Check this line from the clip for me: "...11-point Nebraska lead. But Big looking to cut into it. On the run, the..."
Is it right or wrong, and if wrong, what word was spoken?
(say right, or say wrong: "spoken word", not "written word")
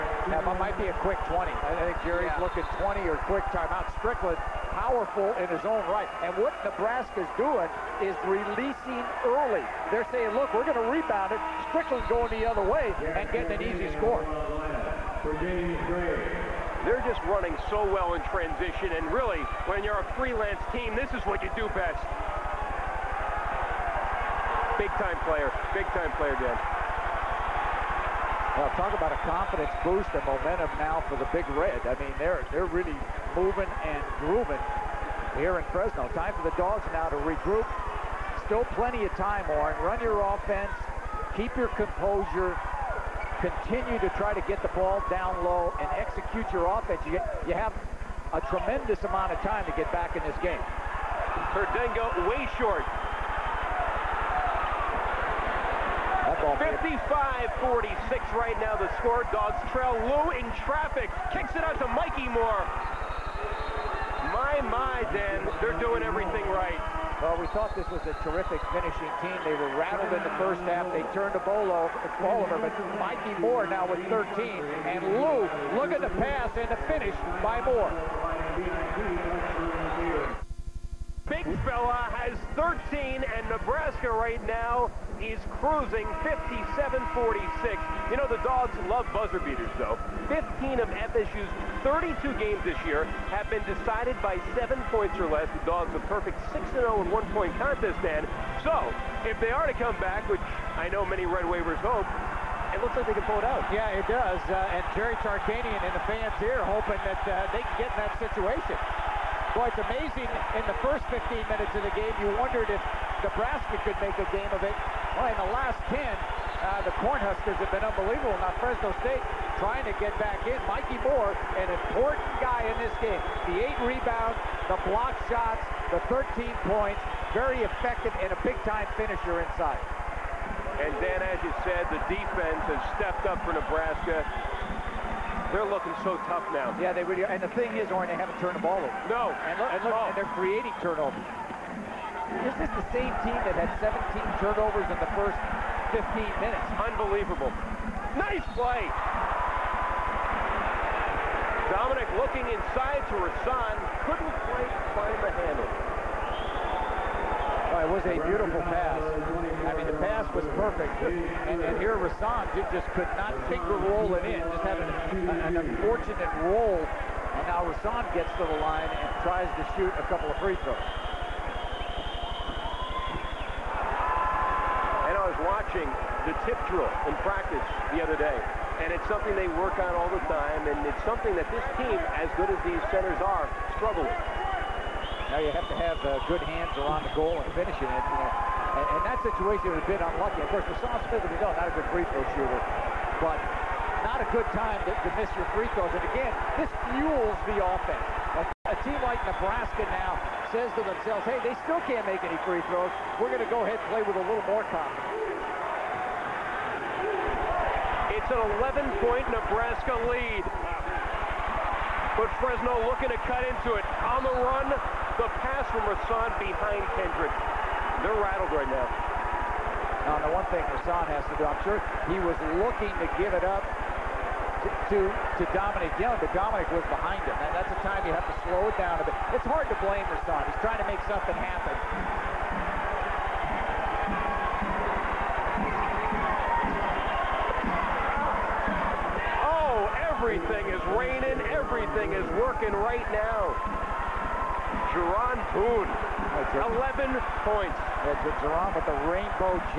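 wrong: "Fresno", not "Big".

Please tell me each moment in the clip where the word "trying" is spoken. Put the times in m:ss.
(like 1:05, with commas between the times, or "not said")
1:59, 3:50.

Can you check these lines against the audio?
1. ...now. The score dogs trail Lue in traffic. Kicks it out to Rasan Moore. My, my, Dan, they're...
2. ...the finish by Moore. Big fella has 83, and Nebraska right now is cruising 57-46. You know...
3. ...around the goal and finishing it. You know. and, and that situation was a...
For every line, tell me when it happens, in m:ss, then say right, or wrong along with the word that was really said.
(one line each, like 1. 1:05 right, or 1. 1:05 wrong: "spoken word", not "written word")
1. 0:58 wrong: "Mikki", not "Rasan"
2. 1:16 wrong: "13", not "83"
3. 3:06 right.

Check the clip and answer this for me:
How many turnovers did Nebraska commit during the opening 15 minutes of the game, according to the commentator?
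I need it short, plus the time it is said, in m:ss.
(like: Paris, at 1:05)
17, at 2:23.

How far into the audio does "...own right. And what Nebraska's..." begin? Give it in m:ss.
0:05.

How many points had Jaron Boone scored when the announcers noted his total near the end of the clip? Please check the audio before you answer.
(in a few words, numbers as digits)
11.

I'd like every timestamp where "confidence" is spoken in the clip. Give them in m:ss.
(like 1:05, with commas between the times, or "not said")
0:29, 3:24.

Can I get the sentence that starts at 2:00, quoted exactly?
Mikki Moore, an important guy in this game.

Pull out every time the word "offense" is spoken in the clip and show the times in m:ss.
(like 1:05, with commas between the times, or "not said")
0:40, 0:46, 3:17.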